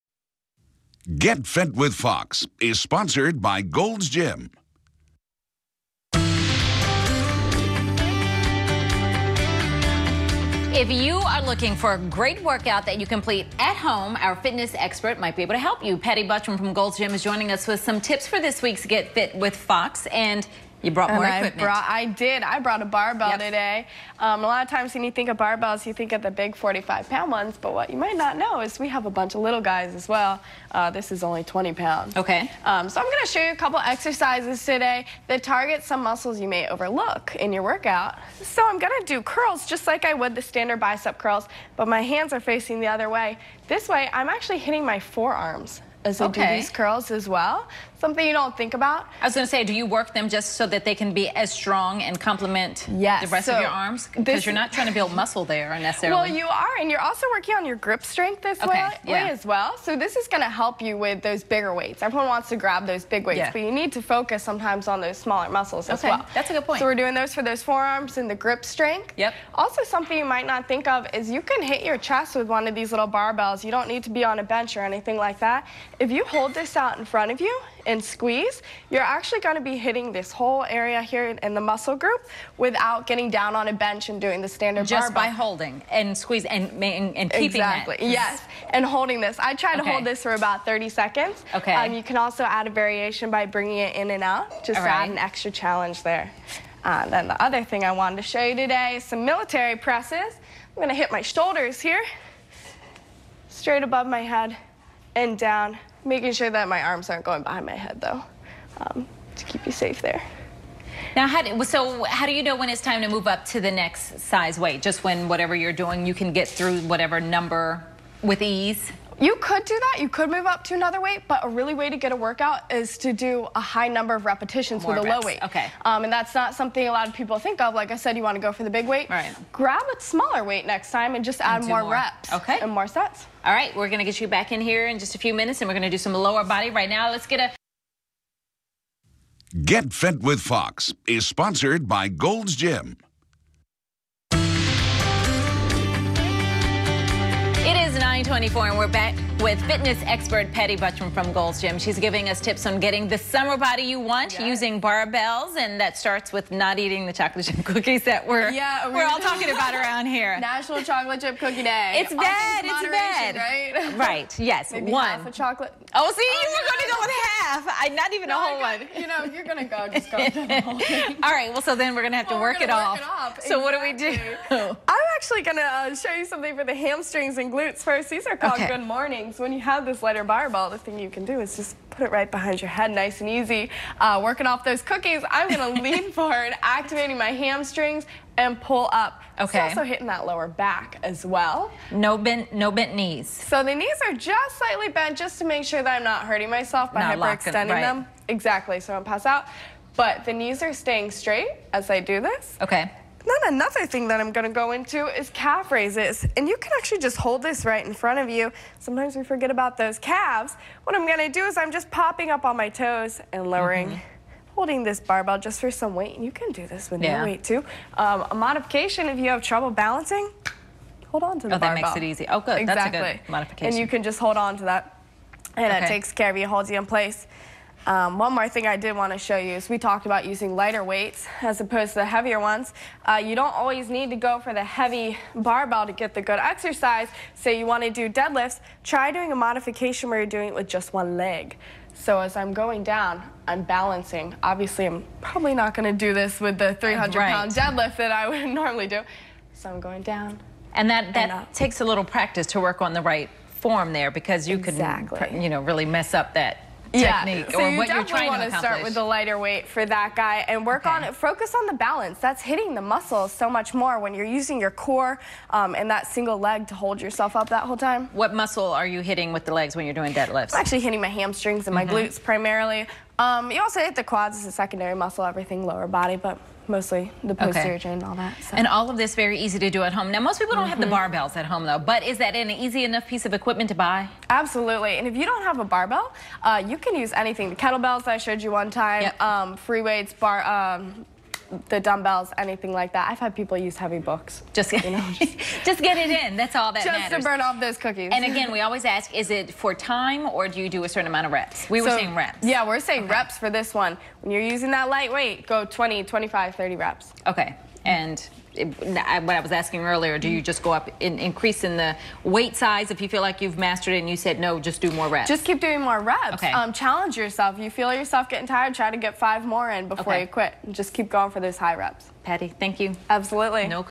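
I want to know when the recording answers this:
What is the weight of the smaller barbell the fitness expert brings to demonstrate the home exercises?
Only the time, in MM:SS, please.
00:31.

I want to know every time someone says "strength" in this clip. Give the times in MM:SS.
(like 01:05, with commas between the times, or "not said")
00:58, 01:08.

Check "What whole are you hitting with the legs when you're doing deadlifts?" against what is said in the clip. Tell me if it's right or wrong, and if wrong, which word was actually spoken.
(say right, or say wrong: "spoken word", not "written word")
wrong: "muscle", not "whole".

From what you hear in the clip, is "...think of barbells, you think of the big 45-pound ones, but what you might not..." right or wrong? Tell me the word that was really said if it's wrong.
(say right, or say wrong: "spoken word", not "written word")
right.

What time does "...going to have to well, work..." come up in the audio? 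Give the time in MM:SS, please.
02:52.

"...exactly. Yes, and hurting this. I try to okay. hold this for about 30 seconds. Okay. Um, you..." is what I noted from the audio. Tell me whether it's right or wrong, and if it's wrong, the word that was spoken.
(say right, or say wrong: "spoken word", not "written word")
wrong: "holding", not "hurting".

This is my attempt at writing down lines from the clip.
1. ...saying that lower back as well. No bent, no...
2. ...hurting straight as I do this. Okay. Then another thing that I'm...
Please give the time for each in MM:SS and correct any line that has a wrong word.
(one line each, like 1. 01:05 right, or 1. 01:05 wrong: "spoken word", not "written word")
1. 03:09 wrong: "hitting", not "saying"
2. 03:20 wrong: "staying", not "hurting".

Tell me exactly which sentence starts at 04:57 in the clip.
Just to burn off those cookies.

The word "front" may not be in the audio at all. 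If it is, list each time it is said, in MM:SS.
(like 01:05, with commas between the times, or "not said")
01:17, 03:27.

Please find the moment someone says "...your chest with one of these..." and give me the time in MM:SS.
01:11.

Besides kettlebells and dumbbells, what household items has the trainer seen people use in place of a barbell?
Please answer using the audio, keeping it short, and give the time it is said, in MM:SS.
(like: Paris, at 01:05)
heavy books, at 04:53.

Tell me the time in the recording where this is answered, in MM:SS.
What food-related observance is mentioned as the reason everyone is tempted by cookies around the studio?
02:40.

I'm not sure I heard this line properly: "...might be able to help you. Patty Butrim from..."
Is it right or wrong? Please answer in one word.
right.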